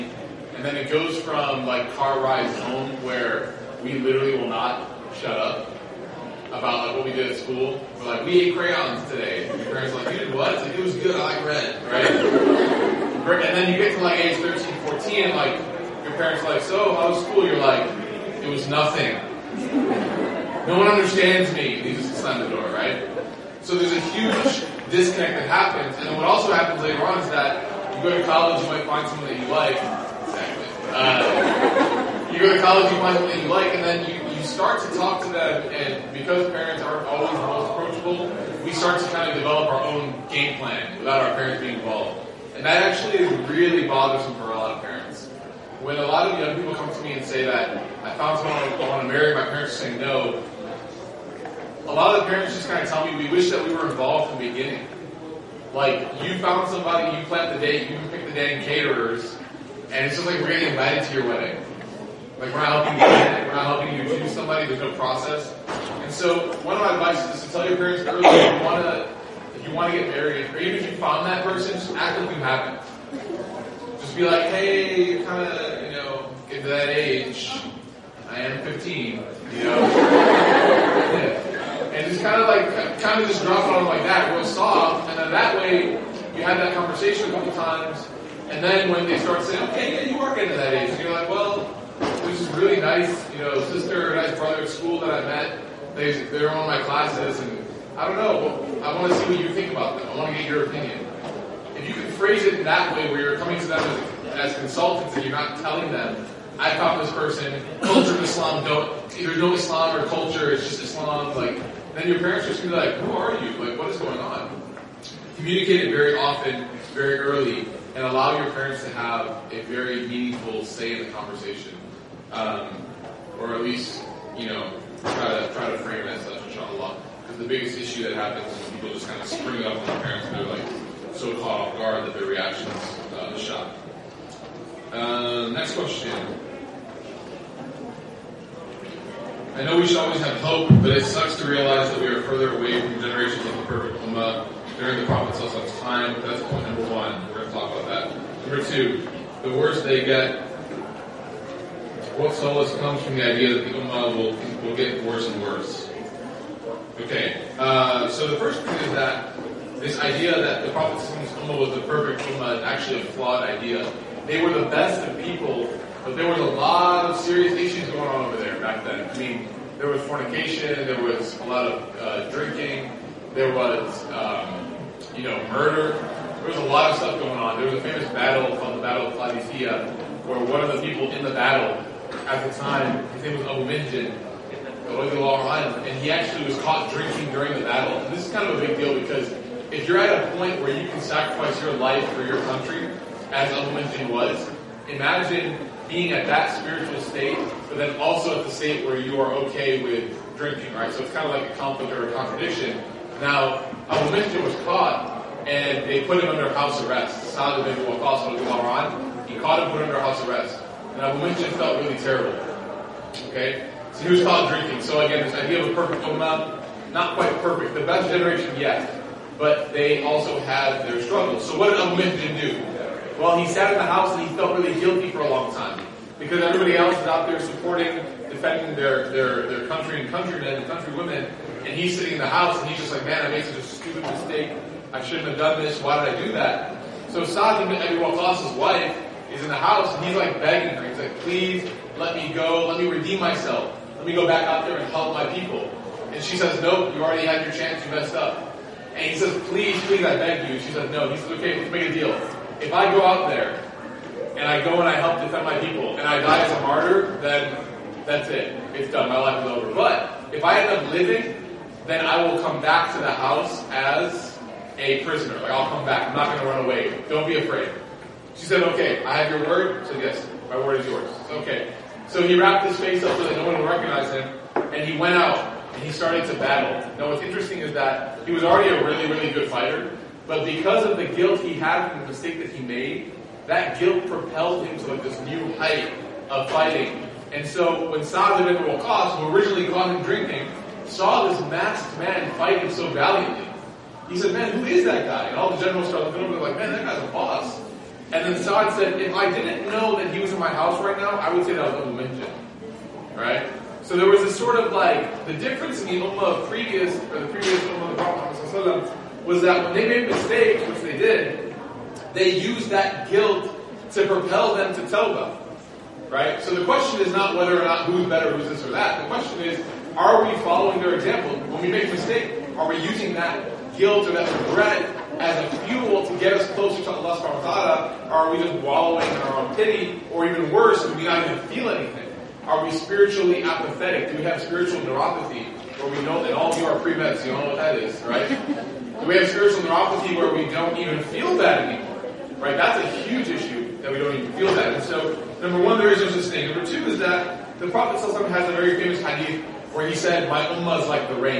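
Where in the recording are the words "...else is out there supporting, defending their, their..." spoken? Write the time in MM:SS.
03:46.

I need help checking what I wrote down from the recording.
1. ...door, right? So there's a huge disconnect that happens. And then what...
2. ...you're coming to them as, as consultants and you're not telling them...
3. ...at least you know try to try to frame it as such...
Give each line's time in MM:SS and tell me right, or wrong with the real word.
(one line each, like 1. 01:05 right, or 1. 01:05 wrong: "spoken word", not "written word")
1. 00:22 right
2. 01:43 right
3. 02:03 right.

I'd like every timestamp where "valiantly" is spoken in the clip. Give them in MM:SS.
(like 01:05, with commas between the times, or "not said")
04:52.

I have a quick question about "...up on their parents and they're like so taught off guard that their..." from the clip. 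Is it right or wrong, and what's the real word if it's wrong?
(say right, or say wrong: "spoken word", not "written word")
wrong: "caught", not "taught".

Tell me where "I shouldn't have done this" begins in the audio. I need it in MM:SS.
03:54.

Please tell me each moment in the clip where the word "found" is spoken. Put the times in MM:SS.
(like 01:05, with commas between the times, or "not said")
00:48, 00:56, 01:10.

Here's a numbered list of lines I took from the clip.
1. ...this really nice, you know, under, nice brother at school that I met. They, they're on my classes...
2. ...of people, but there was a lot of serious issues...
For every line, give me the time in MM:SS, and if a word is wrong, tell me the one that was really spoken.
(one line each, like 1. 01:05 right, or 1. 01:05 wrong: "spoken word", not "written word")
1. 01:32 wrong: "sister", not "under"
2. 02:45 right.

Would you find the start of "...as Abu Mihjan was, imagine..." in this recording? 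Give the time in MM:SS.
03:13.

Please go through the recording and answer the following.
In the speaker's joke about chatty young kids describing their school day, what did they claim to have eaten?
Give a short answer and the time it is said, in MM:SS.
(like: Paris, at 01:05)
Crayons, at 00:08.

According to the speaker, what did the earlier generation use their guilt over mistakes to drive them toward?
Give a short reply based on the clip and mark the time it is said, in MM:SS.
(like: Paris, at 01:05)
Tawbah, at 05:14.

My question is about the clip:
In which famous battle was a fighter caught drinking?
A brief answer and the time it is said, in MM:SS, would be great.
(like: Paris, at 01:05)
Battle of Qadisiyyah, at 02:58.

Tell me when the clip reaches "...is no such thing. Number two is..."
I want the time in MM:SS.
05:45.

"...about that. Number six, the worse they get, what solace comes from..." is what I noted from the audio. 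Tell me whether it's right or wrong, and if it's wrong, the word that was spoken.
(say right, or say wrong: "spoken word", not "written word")
wrong: "two", not "six".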